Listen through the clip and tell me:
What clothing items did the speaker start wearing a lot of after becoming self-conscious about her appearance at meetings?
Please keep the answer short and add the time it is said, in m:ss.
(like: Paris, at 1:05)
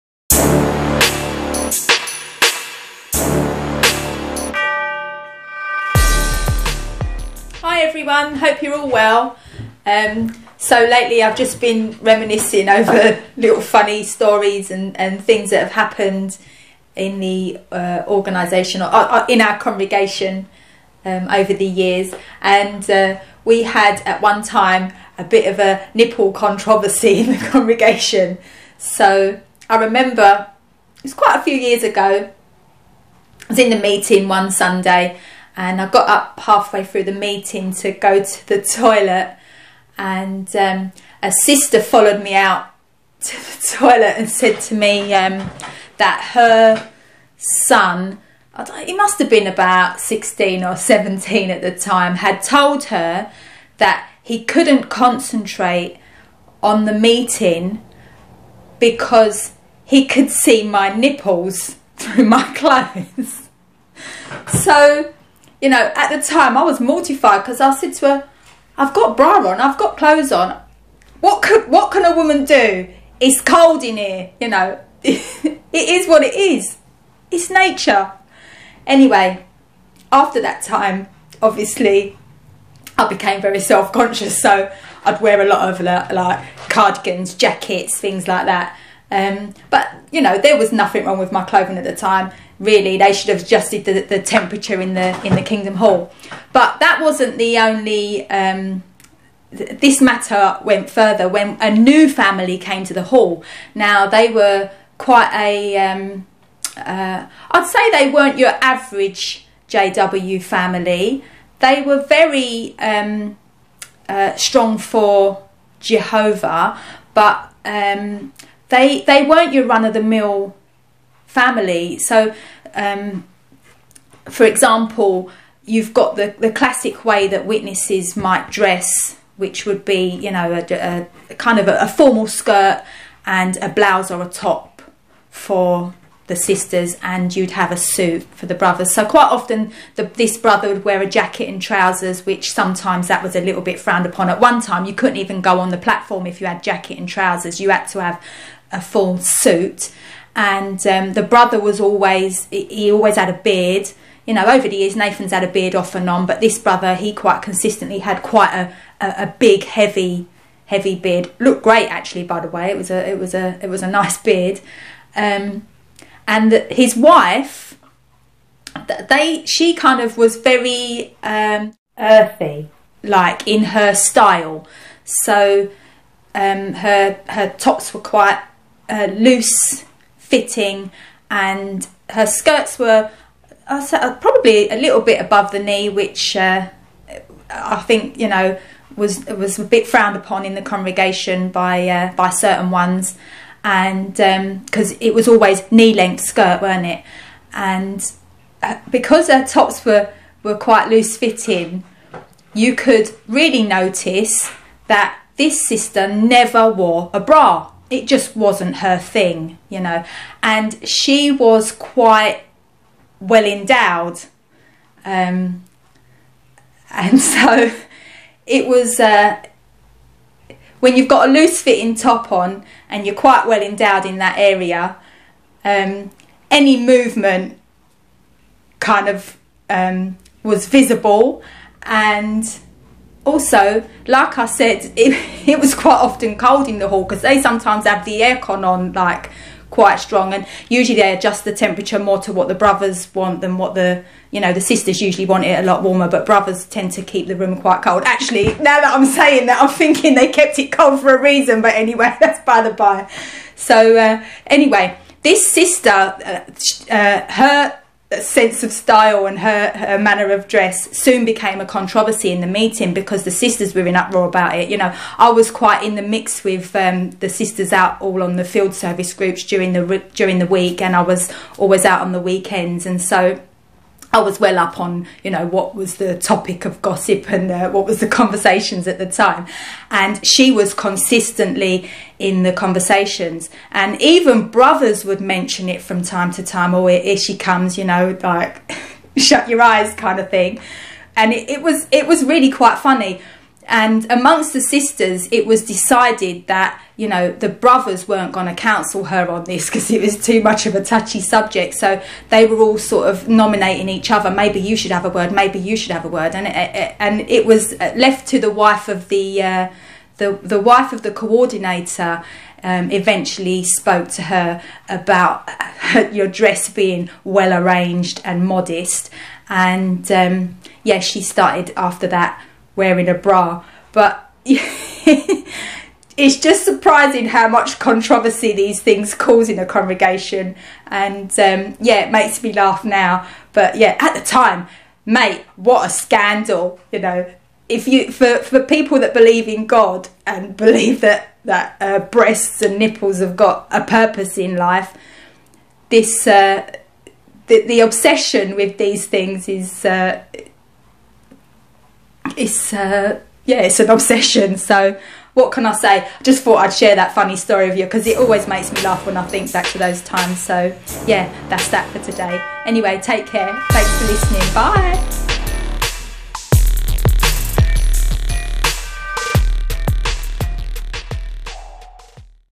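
Cardigans, jackets, at 1:26.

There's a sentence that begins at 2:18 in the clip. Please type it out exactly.
So quite often the, this brother would wear a jacket and trousers, which sometimes that was a little bit frowned upon.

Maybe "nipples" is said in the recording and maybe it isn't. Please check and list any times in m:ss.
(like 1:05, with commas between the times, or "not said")
0:25, 1:00, 5:42.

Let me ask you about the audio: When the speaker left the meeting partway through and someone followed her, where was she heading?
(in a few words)
The toilet.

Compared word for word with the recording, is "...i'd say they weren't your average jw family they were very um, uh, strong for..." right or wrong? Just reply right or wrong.
right.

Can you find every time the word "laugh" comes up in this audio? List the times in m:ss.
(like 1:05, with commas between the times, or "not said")
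5:32, 5:58.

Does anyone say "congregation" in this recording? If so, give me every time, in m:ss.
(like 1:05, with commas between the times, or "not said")
0:19, 0:27, 3:10, 5:29.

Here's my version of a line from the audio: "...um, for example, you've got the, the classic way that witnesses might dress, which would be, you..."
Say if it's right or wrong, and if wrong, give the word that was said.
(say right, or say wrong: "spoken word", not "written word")
right.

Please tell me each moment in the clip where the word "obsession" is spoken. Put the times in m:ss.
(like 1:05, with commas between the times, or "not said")
5:47, 5:53.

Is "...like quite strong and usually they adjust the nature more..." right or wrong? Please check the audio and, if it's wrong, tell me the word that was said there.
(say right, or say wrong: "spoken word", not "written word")
wrong: "temperature", not "nature".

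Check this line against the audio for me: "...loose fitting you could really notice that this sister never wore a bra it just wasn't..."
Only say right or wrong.
right.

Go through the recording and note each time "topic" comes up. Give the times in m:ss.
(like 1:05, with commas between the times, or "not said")
4:36.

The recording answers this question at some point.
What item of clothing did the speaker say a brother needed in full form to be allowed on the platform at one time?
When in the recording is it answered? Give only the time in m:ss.
2:28.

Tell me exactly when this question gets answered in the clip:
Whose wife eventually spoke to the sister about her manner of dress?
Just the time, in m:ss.
5:11.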